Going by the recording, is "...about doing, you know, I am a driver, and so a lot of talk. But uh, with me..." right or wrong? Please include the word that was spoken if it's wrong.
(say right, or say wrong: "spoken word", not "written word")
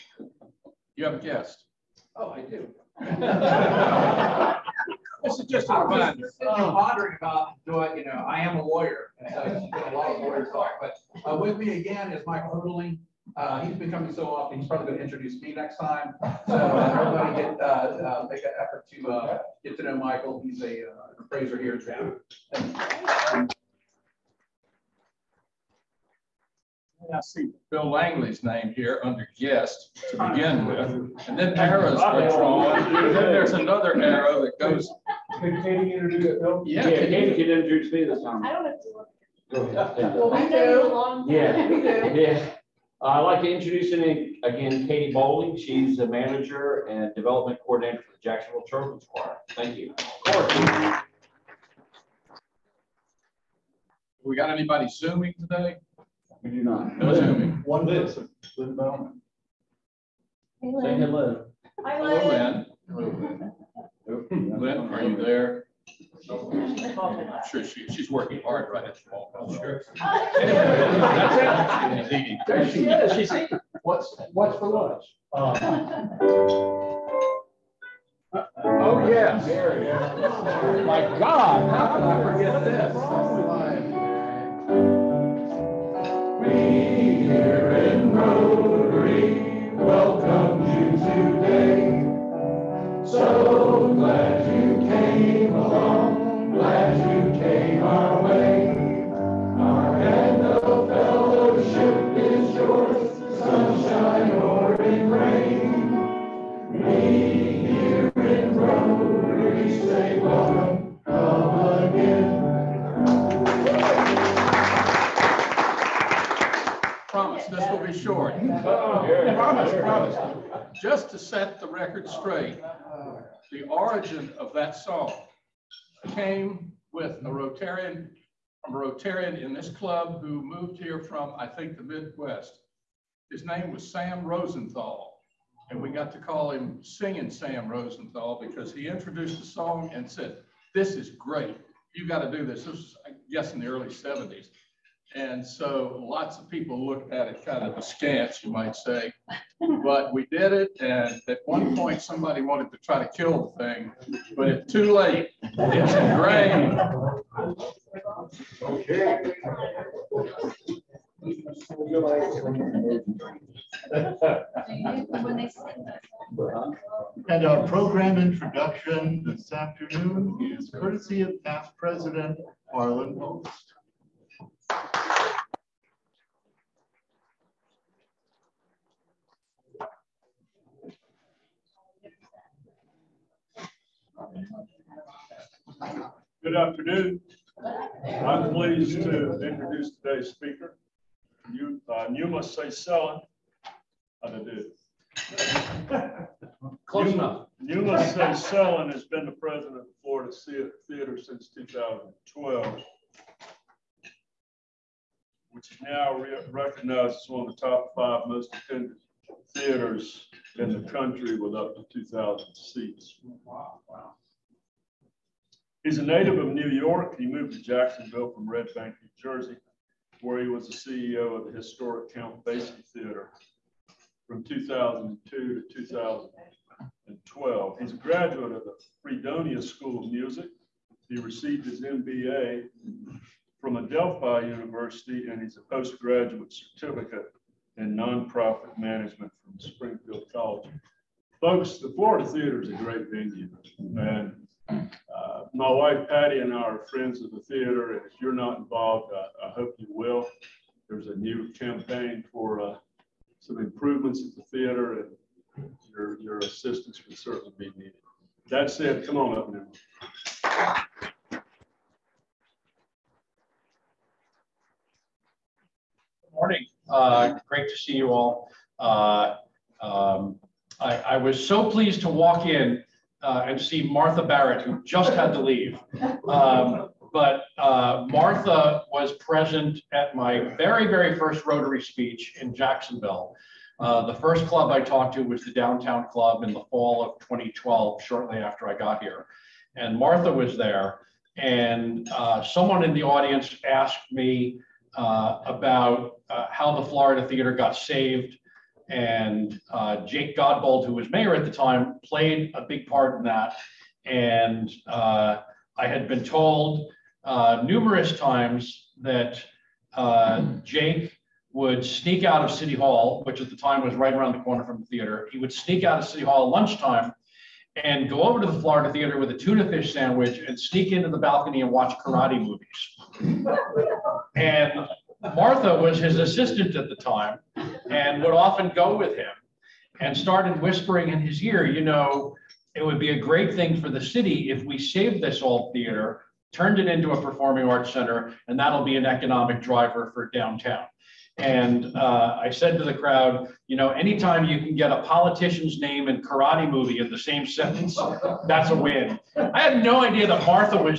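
wrong: "lawyer", not "driver".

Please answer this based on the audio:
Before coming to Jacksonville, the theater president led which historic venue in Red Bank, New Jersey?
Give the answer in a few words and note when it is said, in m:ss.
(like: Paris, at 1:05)
Count Basie Theater, at 3:42.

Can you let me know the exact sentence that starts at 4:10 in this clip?
There's a new campaign for uh, some improvements at the theater, and your, your assistance would certainly be needed.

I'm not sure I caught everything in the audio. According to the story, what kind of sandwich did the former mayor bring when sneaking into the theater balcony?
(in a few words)
tuna fish.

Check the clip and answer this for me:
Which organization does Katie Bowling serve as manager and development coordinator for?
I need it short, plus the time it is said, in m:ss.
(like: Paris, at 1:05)
Jacksonville Children's Choir, at 0:48.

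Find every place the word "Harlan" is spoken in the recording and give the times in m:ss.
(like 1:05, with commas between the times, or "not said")
2:52.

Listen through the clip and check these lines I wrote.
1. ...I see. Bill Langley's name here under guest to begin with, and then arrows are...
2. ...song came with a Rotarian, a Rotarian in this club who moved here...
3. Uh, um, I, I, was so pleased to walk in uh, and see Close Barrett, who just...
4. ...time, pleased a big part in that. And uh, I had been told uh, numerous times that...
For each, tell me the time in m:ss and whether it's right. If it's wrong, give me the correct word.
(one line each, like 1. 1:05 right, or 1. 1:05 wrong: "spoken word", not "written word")
1. 0:27 right
2. 2:04 right
3. 4:28 wrong: "Martha", not "Close"
4. 5:01 wrong: "played", not "pleased".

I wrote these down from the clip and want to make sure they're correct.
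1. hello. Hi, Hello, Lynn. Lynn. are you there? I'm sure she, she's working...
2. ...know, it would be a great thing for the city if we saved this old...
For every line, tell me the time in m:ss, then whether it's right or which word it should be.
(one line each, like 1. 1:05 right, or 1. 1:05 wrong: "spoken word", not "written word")
1. 1:01 right
2. 5:31 right.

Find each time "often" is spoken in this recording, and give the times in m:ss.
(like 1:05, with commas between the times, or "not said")
0:14, 5:28.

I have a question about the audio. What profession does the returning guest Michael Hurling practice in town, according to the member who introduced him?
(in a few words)
appraiser.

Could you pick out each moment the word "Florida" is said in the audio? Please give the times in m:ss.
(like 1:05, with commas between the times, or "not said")
3:20, 4:01, 4:56, 5:18.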